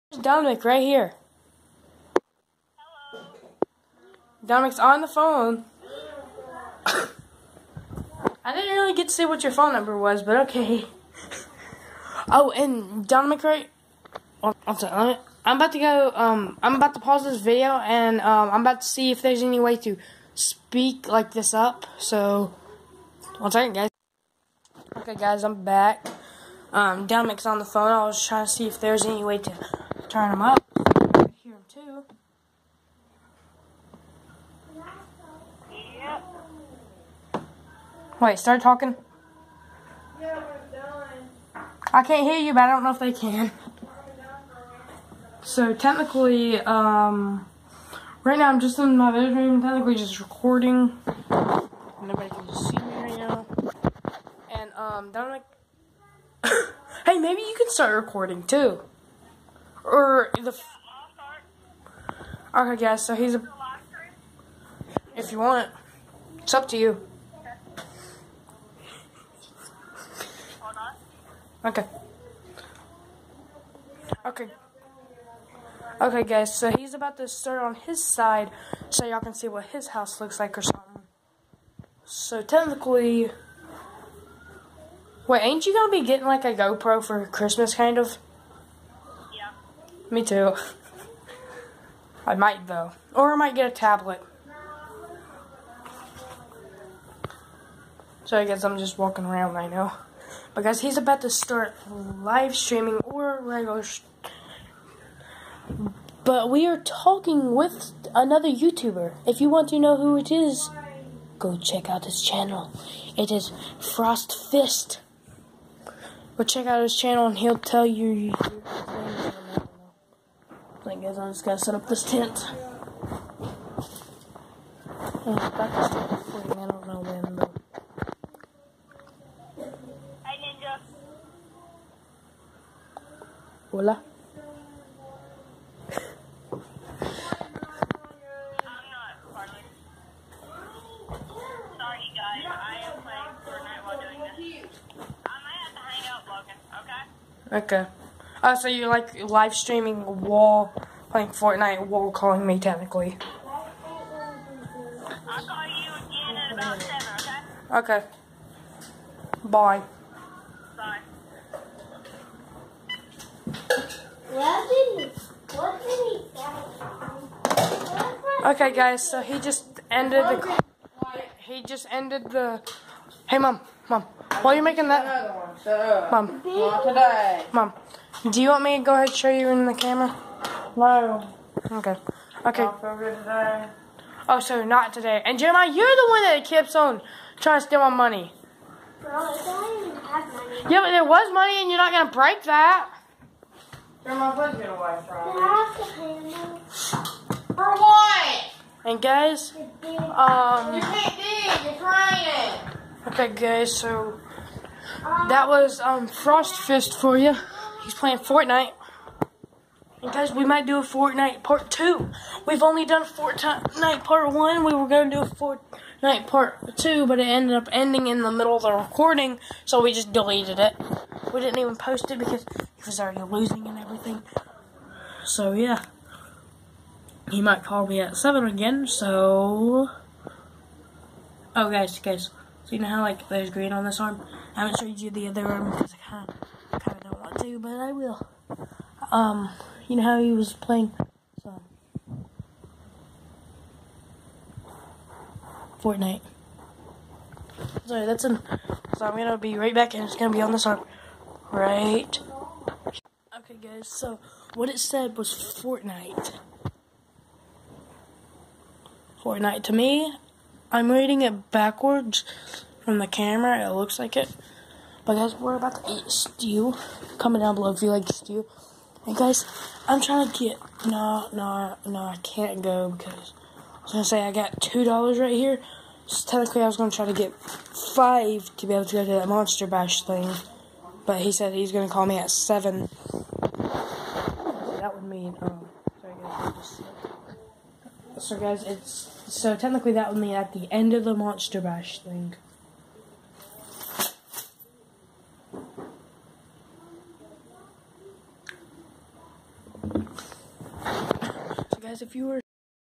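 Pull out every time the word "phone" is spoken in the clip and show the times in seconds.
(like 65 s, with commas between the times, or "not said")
5 s, 9 s, 27 s.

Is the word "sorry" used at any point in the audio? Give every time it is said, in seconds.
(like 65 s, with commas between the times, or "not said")
14 s, 247 s, 285 s.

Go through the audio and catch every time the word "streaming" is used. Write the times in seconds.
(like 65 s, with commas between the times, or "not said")
102 s, 149 s.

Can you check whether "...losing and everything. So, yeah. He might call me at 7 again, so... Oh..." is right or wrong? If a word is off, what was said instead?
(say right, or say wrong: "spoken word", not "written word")
right.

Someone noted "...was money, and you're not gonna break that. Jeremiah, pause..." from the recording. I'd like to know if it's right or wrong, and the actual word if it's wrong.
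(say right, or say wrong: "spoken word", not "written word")
wrong: "please", not "pause".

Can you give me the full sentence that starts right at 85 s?
Wait, ain't you gonna be getting like a GoPro for Christmas, kind of?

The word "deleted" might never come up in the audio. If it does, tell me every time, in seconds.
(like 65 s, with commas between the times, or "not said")
220 s.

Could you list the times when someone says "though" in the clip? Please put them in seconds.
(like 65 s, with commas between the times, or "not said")
92 s, 127 s.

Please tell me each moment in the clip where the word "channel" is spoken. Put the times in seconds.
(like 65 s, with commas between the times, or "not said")
112 s, 116 s.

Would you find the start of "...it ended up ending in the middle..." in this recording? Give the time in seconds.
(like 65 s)
217 s.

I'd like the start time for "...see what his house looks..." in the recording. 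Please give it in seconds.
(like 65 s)
79 s.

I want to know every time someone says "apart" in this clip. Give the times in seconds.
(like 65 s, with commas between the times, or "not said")
not said.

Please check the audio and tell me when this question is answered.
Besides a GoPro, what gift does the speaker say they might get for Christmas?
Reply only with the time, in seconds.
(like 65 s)
93 s.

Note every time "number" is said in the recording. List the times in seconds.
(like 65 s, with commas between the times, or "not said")
9 s.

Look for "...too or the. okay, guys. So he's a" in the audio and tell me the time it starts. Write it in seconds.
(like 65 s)
58 s.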